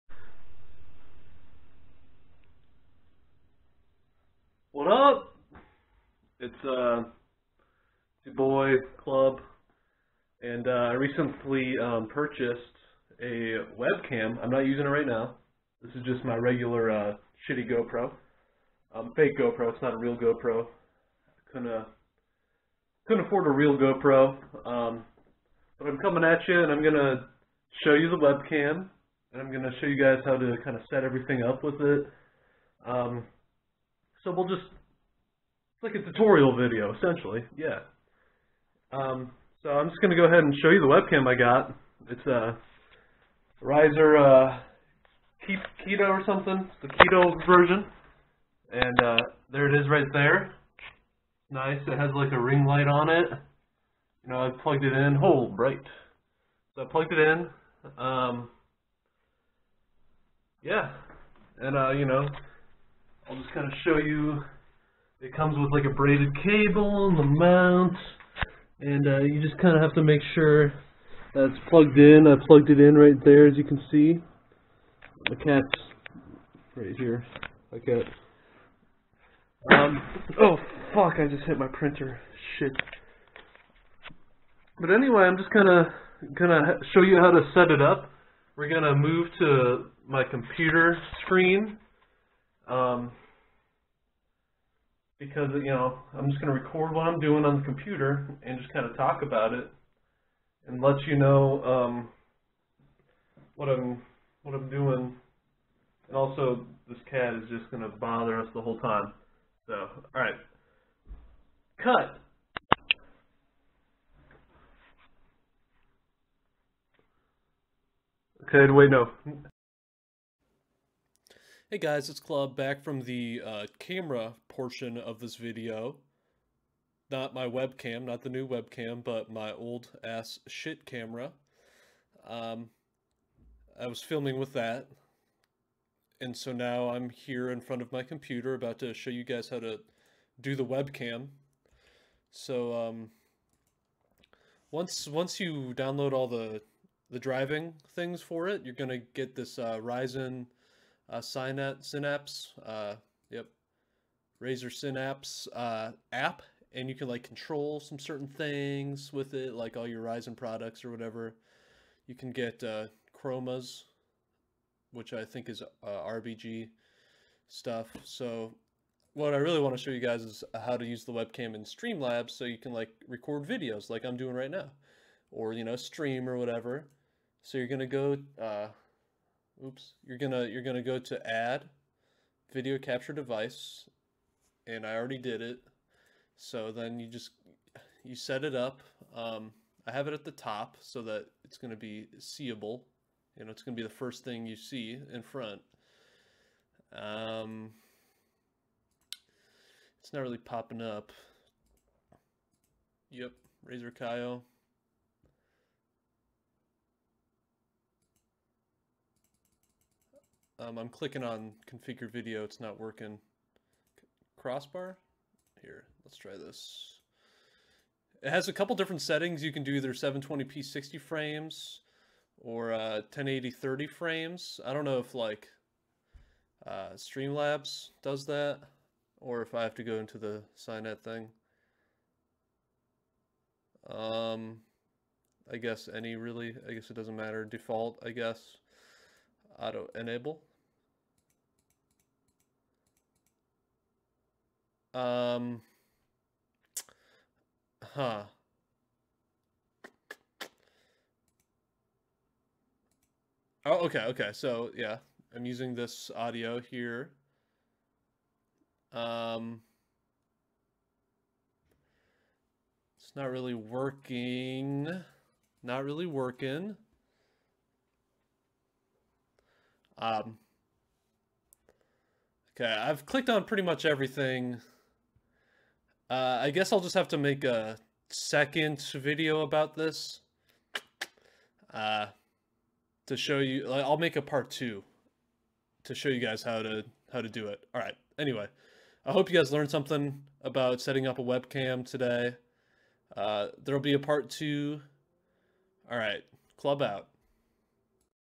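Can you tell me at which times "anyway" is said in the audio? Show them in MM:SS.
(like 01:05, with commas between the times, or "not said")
01:24, 04:48.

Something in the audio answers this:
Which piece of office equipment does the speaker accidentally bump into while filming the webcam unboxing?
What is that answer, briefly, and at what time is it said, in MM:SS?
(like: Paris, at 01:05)
Printer, at 01:21.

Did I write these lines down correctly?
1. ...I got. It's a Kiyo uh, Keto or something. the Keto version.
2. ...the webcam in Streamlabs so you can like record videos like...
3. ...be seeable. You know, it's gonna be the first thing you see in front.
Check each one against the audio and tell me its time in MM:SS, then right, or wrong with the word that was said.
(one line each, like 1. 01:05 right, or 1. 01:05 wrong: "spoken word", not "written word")
1. 00:41 wrong: "Riser", not "Kiyo"
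2. 02:51 right
3. 03:11 right.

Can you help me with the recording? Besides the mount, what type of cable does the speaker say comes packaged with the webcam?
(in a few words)
Braided cable.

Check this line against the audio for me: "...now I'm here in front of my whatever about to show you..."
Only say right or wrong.
wrong.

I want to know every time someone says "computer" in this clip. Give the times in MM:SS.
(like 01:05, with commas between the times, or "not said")
01:30, 01:37, 02:18.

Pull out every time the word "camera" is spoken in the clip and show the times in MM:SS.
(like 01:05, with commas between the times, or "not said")
02:03, 02:10.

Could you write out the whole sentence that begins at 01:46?
And also, this cat is just going to bother us the whole time.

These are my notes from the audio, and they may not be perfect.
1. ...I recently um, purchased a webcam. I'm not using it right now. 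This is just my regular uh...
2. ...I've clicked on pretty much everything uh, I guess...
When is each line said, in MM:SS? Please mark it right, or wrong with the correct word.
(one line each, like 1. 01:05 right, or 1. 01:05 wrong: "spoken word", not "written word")
1. 00:10 right
2. 04:32 right.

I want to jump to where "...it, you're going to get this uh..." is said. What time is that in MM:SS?
02:28.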